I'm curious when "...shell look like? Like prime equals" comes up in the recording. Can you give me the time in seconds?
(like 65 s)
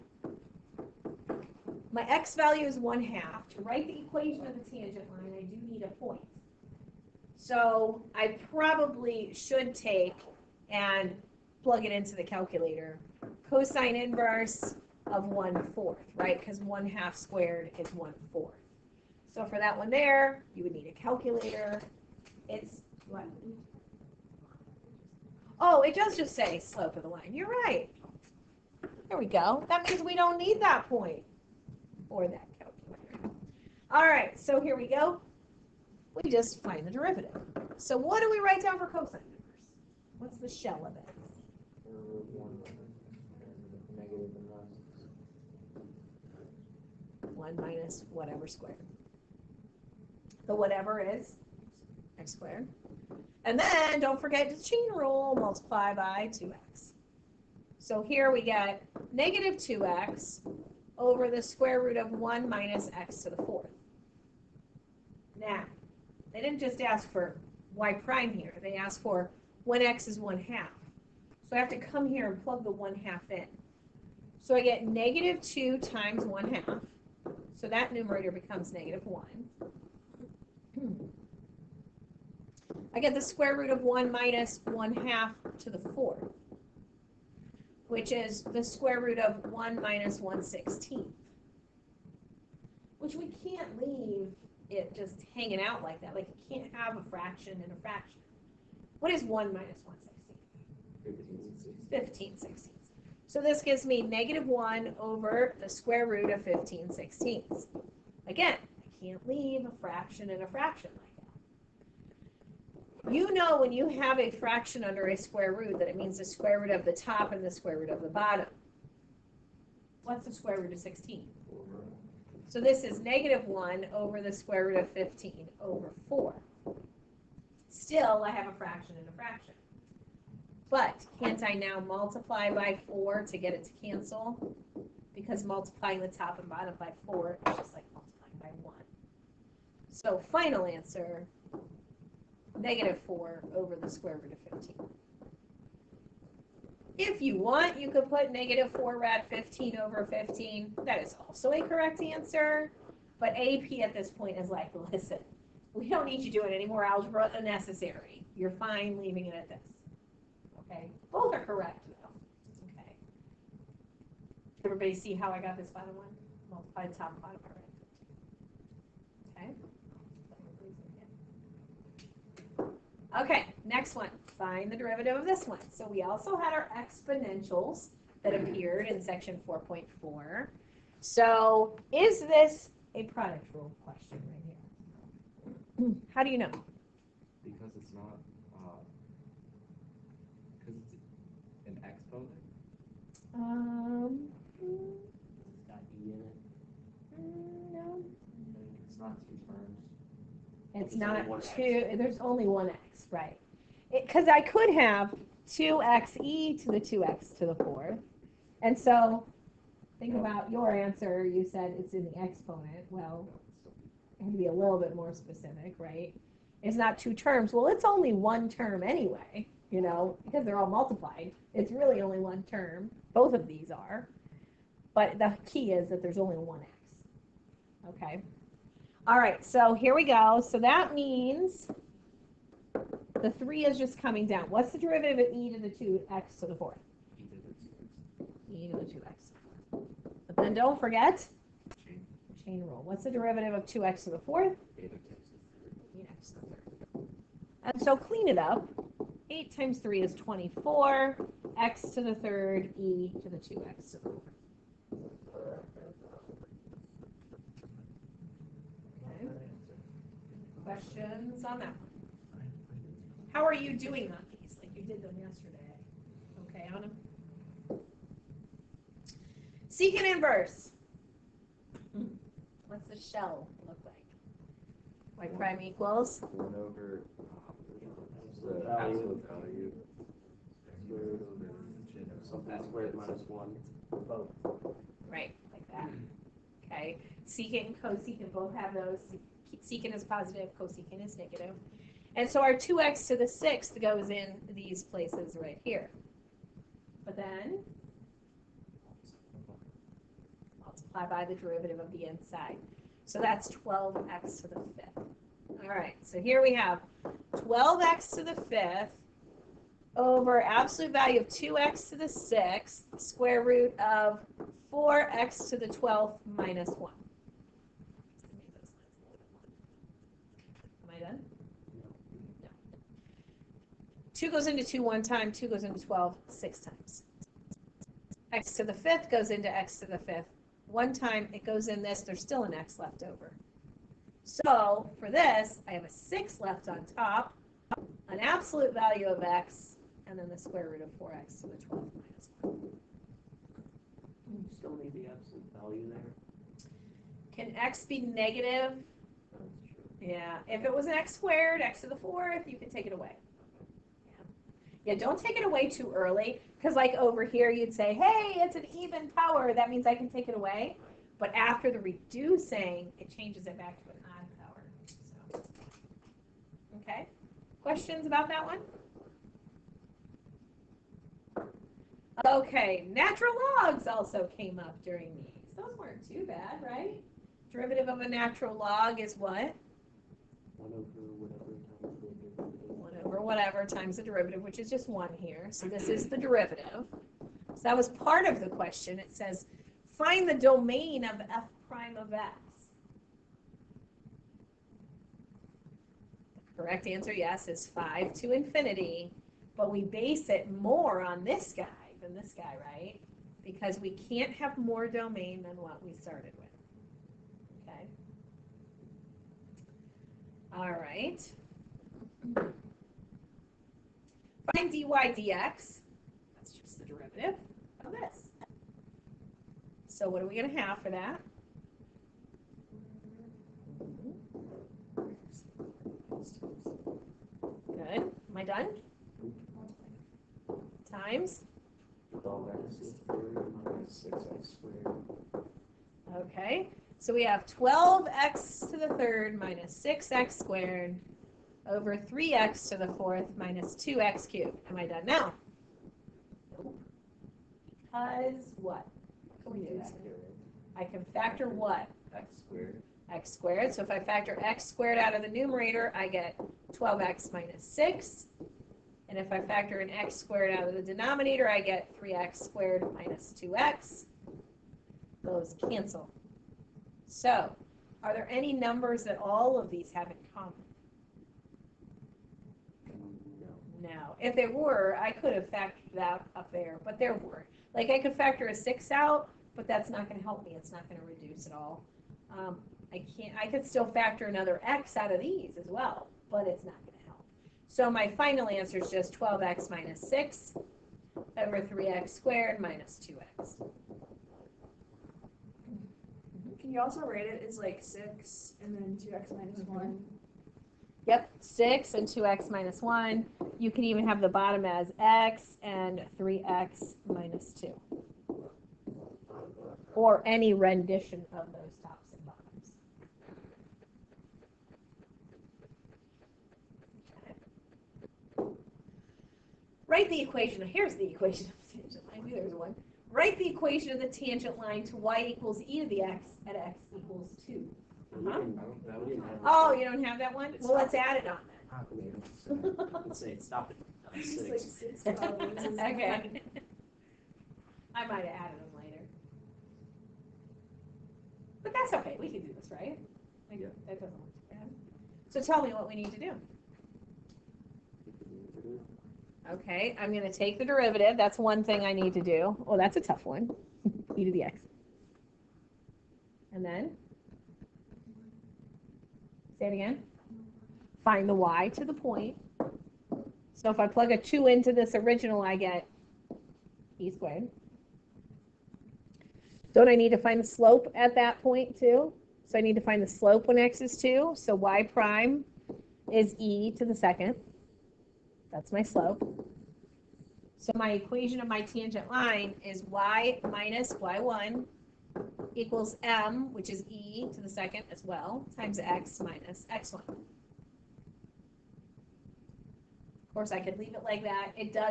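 272 s.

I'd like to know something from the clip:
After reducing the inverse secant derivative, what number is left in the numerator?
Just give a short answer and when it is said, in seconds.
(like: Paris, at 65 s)
6, at 335 s.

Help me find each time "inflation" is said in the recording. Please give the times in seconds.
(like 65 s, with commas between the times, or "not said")
not said.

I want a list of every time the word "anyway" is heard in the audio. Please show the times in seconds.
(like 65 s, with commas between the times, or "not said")
218 s.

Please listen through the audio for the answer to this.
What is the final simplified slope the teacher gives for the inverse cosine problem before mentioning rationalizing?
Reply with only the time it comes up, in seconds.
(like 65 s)
142 s.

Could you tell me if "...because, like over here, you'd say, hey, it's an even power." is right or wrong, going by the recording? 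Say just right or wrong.
right.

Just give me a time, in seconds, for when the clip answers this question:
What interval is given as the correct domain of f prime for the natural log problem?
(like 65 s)
397 s.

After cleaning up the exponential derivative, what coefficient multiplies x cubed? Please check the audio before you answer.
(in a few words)
24.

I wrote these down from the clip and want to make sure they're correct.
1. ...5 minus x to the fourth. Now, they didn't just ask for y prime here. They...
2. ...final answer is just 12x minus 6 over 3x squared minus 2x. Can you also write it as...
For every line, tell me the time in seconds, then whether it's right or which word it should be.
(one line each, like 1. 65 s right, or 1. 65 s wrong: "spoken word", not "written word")
1. 62 s wrong: "1", not "5"
2. 488 s right.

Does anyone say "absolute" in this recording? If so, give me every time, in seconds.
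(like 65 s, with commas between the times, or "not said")
310 s, 338 s, 345 s.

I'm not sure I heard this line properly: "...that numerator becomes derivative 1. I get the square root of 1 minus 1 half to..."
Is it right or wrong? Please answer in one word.
wrong.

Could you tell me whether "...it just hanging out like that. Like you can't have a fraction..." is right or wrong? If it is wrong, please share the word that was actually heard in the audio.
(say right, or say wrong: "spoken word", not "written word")
right.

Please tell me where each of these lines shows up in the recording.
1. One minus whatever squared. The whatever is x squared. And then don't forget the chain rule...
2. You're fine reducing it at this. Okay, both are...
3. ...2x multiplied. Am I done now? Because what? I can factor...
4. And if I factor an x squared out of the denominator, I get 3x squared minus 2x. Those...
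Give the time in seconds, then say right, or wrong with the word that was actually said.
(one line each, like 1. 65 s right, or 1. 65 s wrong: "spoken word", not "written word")
1. 47 s right
2. 158 s wrong: "leaving", not "reducing"
3. 443 s wrong: "cubed", not "multiplied"
4. 459 s right.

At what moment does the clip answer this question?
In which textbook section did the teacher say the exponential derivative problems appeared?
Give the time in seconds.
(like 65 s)
178 s.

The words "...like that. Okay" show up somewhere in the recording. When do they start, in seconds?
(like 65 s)
285 s.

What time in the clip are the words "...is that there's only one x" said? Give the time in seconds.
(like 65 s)
225 s.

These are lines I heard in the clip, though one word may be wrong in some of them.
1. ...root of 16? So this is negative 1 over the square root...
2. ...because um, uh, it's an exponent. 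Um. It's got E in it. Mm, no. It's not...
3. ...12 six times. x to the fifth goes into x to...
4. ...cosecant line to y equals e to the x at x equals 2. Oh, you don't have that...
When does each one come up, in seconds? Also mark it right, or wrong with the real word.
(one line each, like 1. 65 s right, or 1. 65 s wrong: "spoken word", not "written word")
1. 120 s right
2. 190 s right
3. 325 s right
4. 524 s wrong: "tangent", not "cosecant".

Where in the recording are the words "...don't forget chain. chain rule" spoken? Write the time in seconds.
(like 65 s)
240 s.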